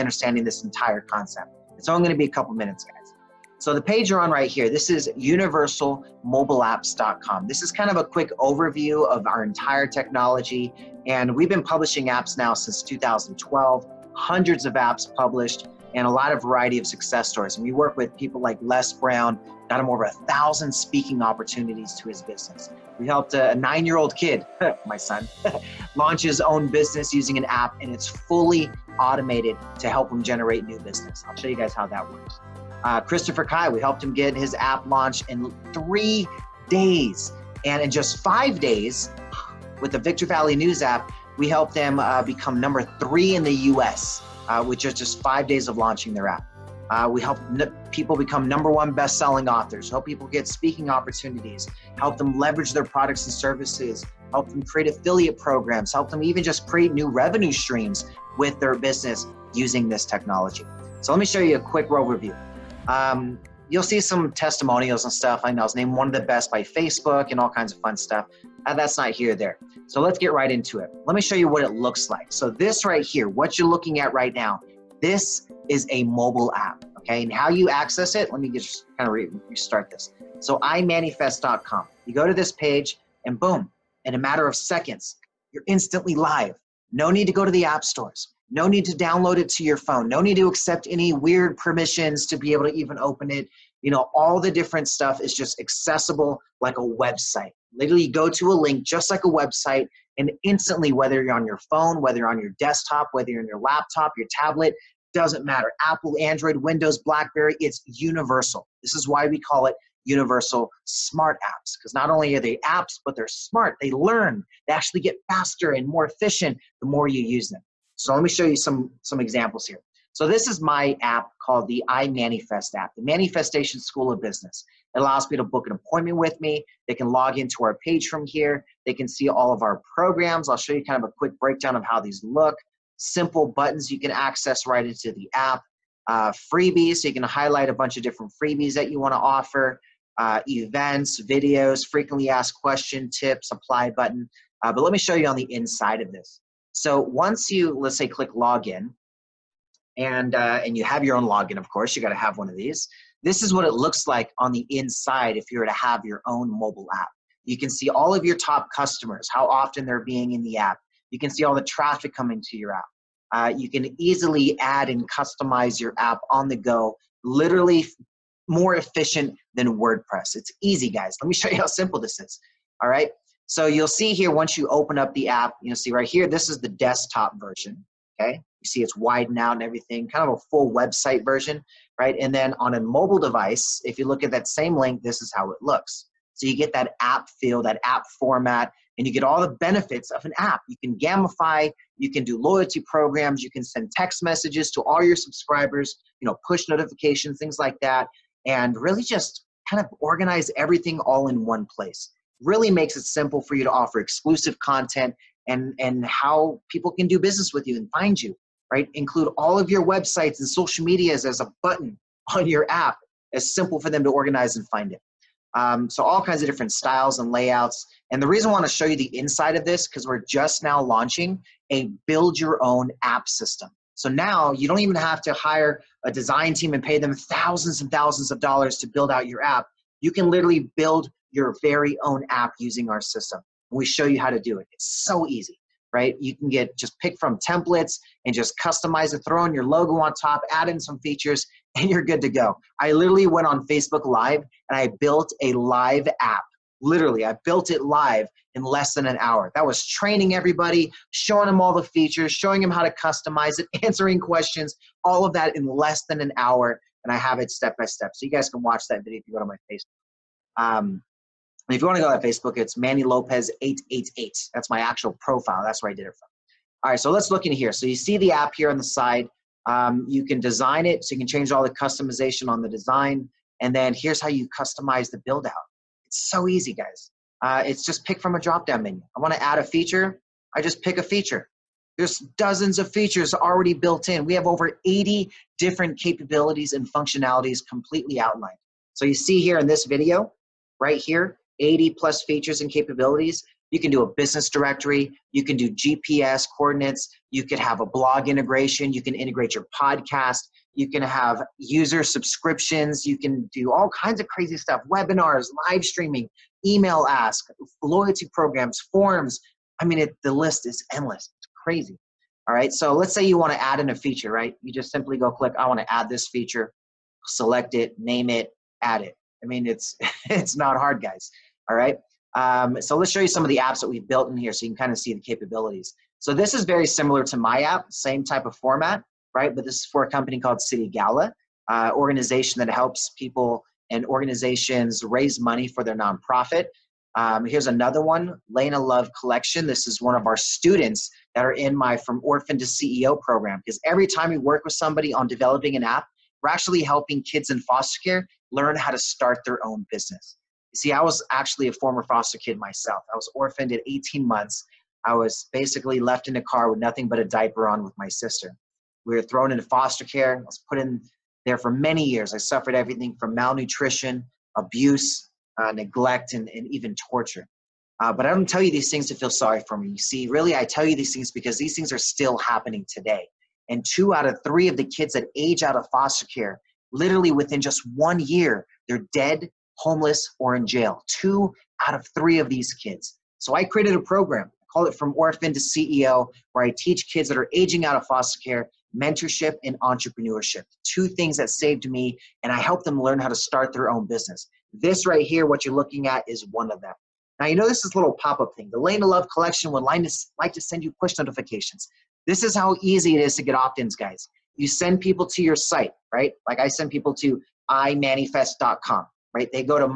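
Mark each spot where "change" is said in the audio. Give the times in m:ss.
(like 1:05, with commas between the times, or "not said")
4:31.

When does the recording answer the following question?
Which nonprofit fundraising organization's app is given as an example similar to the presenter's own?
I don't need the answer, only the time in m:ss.
5:30.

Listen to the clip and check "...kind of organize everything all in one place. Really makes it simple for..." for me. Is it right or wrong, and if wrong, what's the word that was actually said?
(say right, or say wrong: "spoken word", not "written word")
right.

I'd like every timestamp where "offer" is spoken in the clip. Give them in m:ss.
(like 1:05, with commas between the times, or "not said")
2:19, 3:23.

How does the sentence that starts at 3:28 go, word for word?
Include all of your websites and social medias as a button on your app.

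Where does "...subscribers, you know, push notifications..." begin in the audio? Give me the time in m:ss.
3:15.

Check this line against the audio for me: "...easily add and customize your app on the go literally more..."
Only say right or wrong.
right.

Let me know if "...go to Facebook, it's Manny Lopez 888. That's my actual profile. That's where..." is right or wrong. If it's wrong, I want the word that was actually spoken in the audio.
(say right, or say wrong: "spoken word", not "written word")
right.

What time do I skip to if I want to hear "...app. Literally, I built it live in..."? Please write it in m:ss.
4:06.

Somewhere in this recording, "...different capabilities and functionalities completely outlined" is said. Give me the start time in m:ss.
4:45.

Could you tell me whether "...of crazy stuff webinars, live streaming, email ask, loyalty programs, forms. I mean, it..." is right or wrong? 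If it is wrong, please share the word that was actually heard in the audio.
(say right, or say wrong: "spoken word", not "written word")
right.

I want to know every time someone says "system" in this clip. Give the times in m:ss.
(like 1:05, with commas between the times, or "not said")
3:43, 3:52.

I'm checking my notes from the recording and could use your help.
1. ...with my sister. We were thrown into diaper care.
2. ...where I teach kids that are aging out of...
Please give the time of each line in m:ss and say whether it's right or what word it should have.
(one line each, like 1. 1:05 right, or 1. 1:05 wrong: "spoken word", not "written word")
1. 5:57 wrong: "foster", not "diaper"
2. 6:26 right.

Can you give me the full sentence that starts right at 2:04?
It allows people to book an appointment with me.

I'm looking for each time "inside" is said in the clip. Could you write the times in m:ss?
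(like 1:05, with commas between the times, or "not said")
2:25, 2:34, 3:39.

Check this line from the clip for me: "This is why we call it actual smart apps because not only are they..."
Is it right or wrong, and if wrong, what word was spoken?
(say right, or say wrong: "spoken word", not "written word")
wrong: "universal", not "actual".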